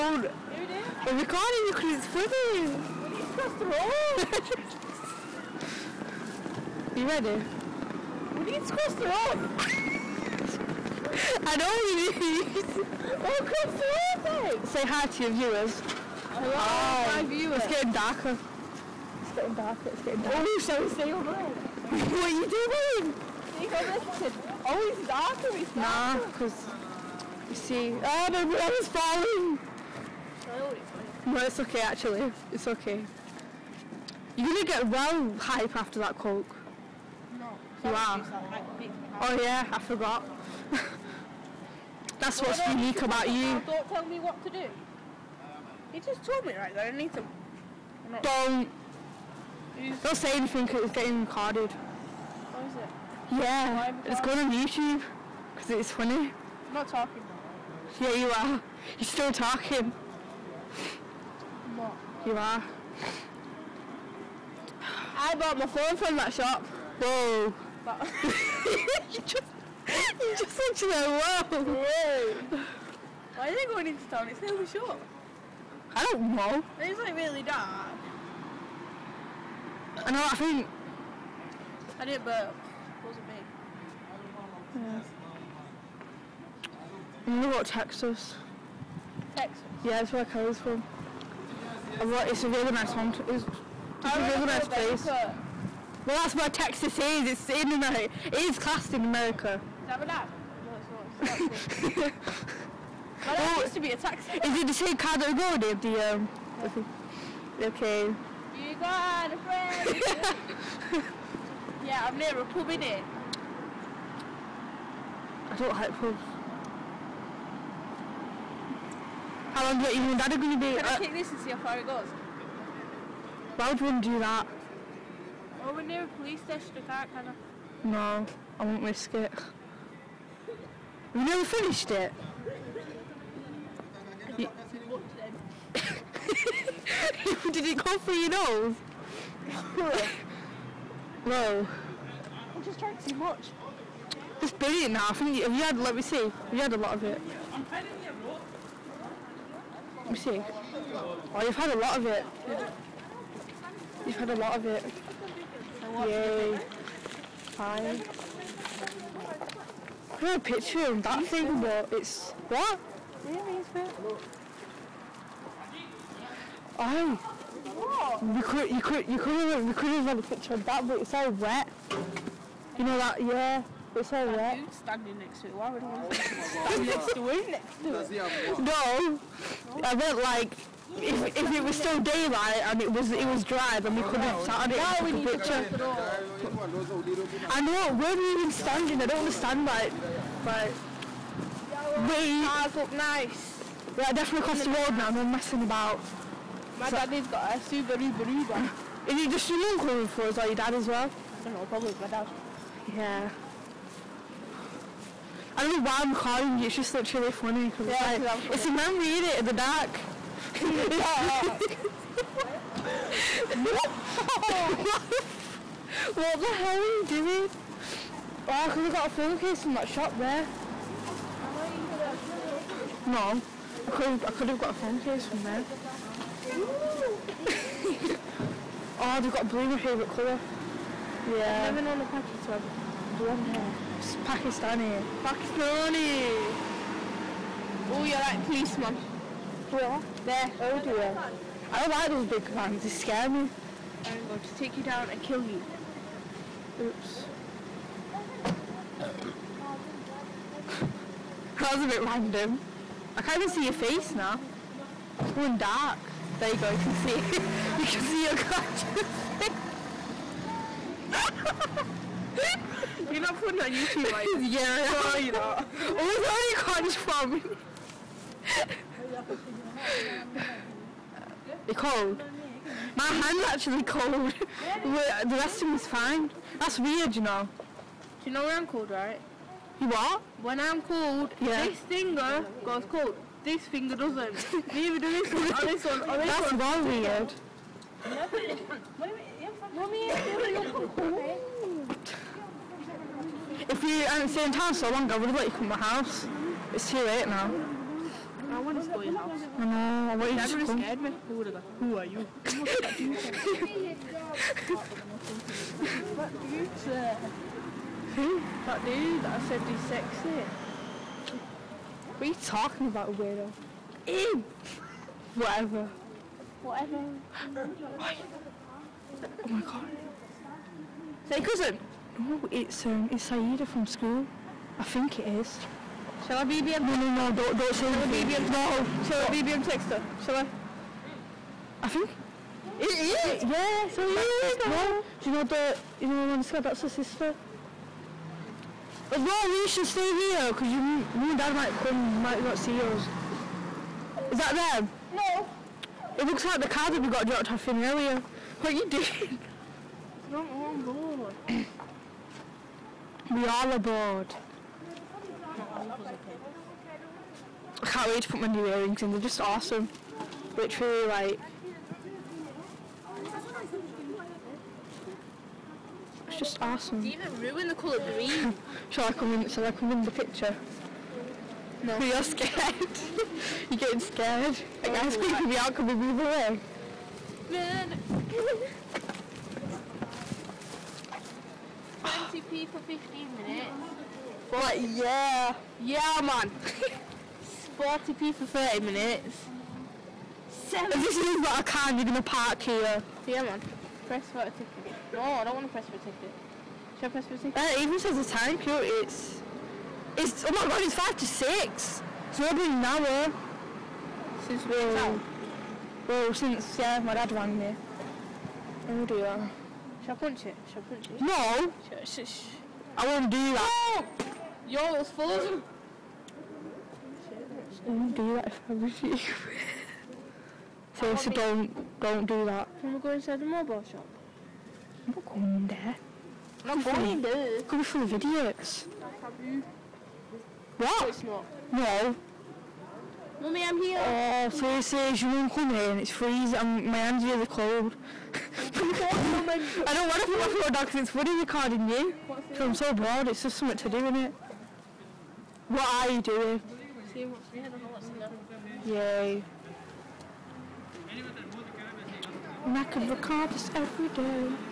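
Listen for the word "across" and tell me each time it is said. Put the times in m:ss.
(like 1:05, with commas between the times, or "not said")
0:02, 3:14.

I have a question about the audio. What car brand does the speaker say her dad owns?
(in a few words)
Subaru.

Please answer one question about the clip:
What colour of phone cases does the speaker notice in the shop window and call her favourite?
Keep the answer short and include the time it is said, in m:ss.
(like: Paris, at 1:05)
Blue, at 3:49.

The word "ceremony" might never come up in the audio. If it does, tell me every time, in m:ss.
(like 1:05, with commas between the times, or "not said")
not said.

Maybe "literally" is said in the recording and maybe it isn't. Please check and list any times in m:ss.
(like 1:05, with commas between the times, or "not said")
1:10, 3:26, 6:00.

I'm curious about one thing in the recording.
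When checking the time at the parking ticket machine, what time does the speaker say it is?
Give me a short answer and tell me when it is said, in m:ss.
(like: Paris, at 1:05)
5 to 6, at 6:40.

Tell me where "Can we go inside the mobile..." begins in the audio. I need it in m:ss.
7:02.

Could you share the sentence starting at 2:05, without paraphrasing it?
Well, we're near a police station, I can't, No, I won't risk it.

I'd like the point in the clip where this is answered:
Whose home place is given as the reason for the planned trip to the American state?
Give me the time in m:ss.
1:30.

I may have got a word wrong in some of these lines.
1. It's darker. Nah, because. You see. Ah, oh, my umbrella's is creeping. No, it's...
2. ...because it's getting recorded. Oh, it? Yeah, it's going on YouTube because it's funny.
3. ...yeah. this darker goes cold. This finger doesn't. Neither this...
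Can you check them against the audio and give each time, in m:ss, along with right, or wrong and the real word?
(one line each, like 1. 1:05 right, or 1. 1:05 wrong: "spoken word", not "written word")
1. 0:25 wrong: "falling", not "creeping"
2. 0:50 right
3. 4:41 wrong: "finger", not "darker".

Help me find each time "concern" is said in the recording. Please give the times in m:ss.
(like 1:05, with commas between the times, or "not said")
not said.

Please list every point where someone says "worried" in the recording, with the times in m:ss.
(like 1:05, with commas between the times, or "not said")
not said.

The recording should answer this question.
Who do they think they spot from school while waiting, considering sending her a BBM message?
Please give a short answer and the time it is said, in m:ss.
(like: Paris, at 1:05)
Saida, at 5:23.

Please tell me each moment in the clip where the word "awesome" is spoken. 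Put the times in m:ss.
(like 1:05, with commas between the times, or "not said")
5:59, 6:06.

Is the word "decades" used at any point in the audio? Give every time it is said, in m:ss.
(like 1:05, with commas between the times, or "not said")
not said.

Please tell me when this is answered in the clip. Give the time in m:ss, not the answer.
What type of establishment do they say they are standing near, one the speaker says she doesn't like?
1:52.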